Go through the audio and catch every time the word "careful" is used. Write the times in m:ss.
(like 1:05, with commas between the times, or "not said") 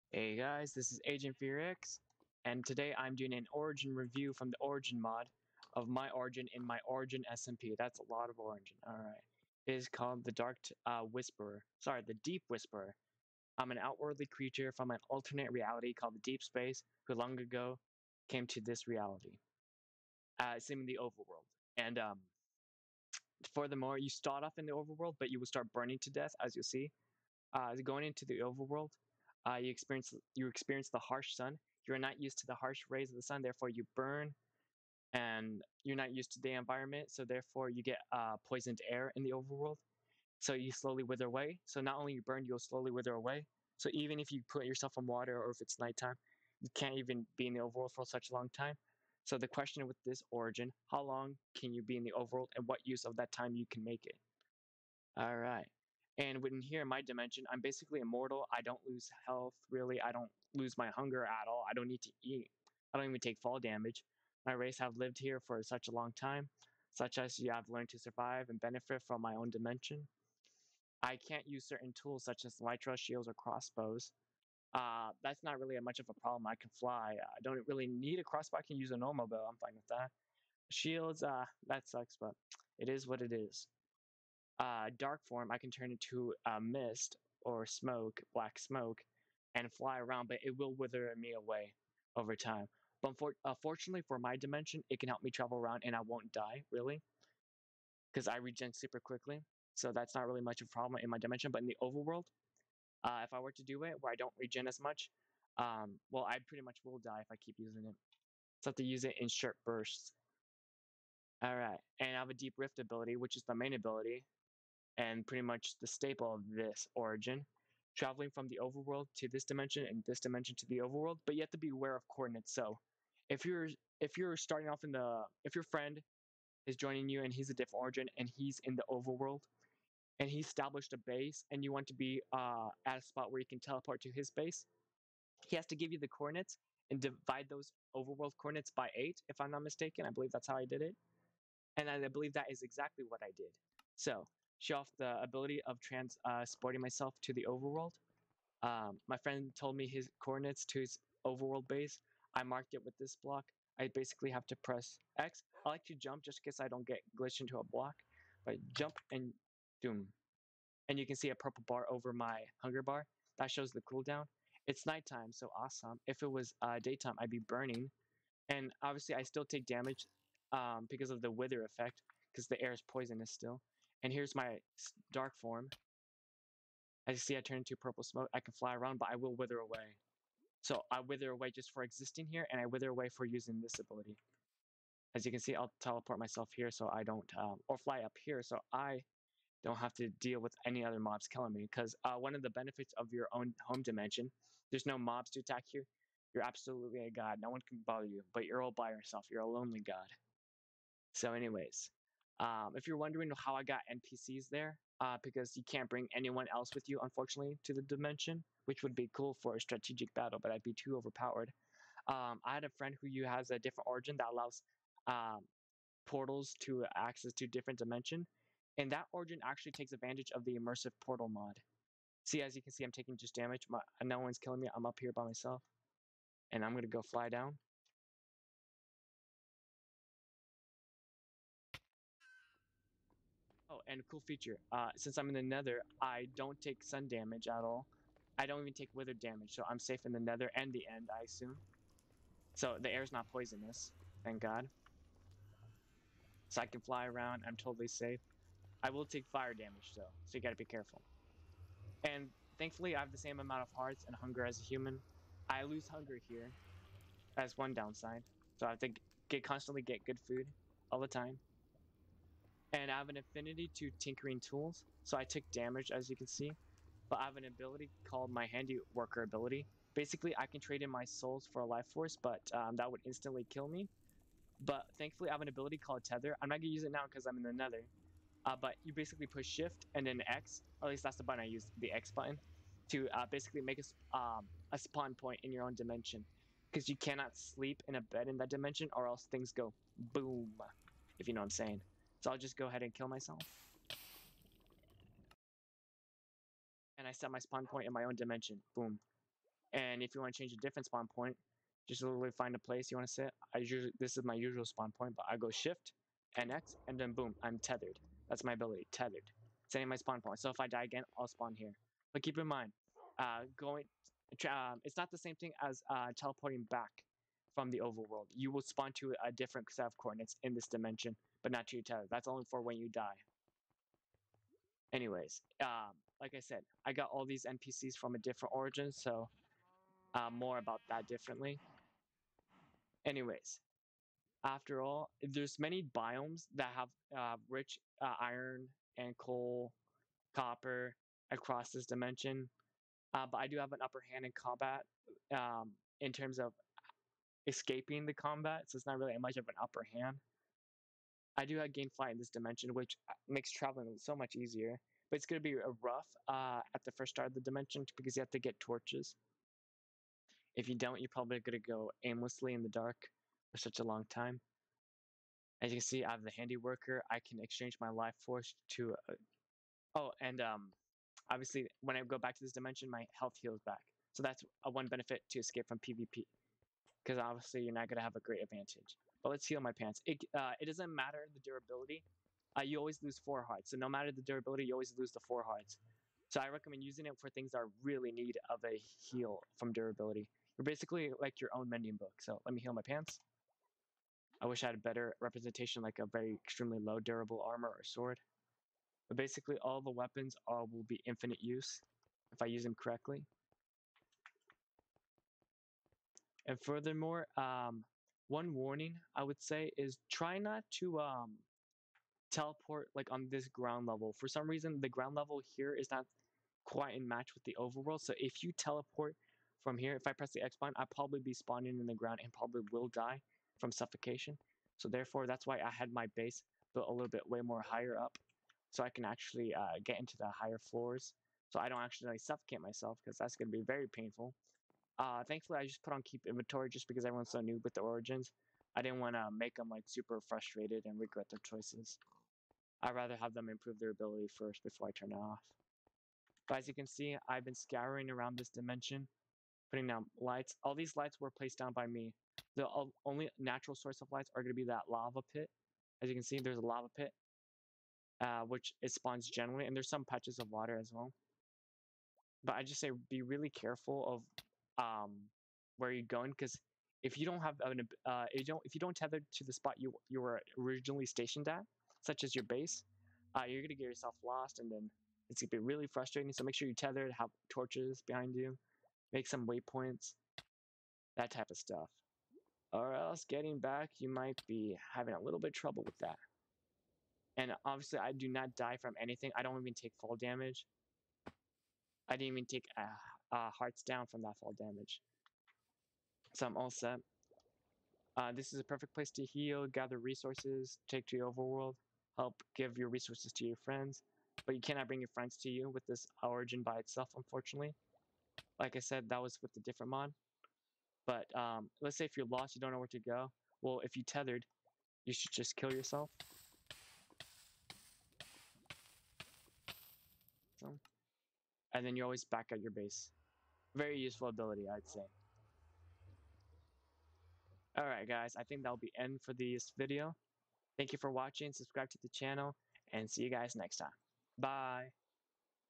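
4:10, 7:43.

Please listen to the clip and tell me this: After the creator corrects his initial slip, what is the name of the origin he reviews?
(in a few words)
Deep Whisperer.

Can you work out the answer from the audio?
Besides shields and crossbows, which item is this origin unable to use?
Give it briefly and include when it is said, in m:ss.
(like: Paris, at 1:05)
elytra, at 1:12.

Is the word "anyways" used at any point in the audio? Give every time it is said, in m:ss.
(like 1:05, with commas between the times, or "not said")
3:21, 5:24, 5:33.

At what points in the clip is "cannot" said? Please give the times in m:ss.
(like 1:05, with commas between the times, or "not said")
4:46, 8:24.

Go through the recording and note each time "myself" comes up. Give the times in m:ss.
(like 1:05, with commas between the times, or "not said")
2:26, 3:06, 3:45, 4:53, 7:12.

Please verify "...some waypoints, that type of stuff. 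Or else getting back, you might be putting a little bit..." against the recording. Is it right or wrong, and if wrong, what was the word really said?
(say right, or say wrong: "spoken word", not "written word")
wrong: "having", not "putting".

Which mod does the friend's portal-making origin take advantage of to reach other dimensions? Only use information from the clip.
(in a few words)
immersive portal mod.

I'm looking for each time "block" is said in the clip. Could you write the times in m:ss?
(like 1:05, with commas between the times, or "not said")
2:33, 2:37.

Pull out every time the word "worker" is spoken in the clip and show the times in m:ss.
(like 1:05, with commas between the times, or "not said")
4:28, 6:06.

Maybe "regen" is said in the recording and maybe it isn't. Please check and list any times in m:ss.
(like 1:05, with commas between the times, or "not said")
1:38, 1:44.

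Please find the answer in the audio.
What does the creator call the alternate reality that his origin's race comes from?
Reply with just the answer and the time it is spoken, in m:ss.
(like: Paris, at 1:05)
Deep Space, at 0:16.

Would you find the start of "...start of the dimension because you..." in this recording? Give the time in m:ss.
5:57.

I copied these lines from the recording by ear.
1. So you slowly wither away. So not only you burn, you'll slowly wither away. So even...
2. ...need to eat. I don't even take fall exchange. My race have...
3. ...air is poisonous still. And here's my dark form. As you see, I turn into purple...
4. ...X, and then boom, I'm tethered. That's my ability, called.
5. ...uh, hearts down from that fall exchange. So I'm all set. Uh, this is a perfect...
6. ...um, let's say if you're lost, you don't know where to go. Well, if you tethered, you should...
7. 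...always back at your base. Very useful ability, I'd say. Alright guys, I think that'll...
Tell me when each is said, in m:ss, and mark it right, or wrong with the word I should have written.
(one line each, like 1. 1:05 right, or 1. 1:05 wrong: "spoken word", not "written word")
1. 0:40 right
2. 1:01 wrong: "damage", not "exchange"
3. 2:52 right
4. 5:06 wrong: "tethered", not "called"
5. 8:13 wrong: "damage", not "exchange"
6. 8:31 right
7. 8:42 right.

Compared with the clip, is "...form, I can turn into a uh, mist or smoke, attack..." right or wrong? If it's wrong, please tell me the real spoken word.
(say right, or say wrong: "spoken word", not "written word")
wrong: "black", not "attack".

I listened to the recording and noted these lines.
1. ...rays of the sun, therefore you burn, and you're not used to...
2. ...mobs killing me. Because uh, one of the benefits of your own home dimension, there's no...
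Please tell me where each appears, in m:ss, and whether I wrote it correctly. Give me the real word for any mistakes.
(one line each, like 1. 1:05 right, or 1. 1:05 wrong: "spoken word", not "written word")
1. 0:32 right
2. 3:10 right.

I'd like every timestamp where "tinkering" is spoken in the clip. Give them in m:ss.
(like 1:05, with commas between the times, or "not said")
4:23.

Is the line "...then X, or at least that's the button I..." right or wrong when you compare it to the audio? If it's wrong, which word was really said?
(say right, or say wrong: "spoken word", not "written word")
right.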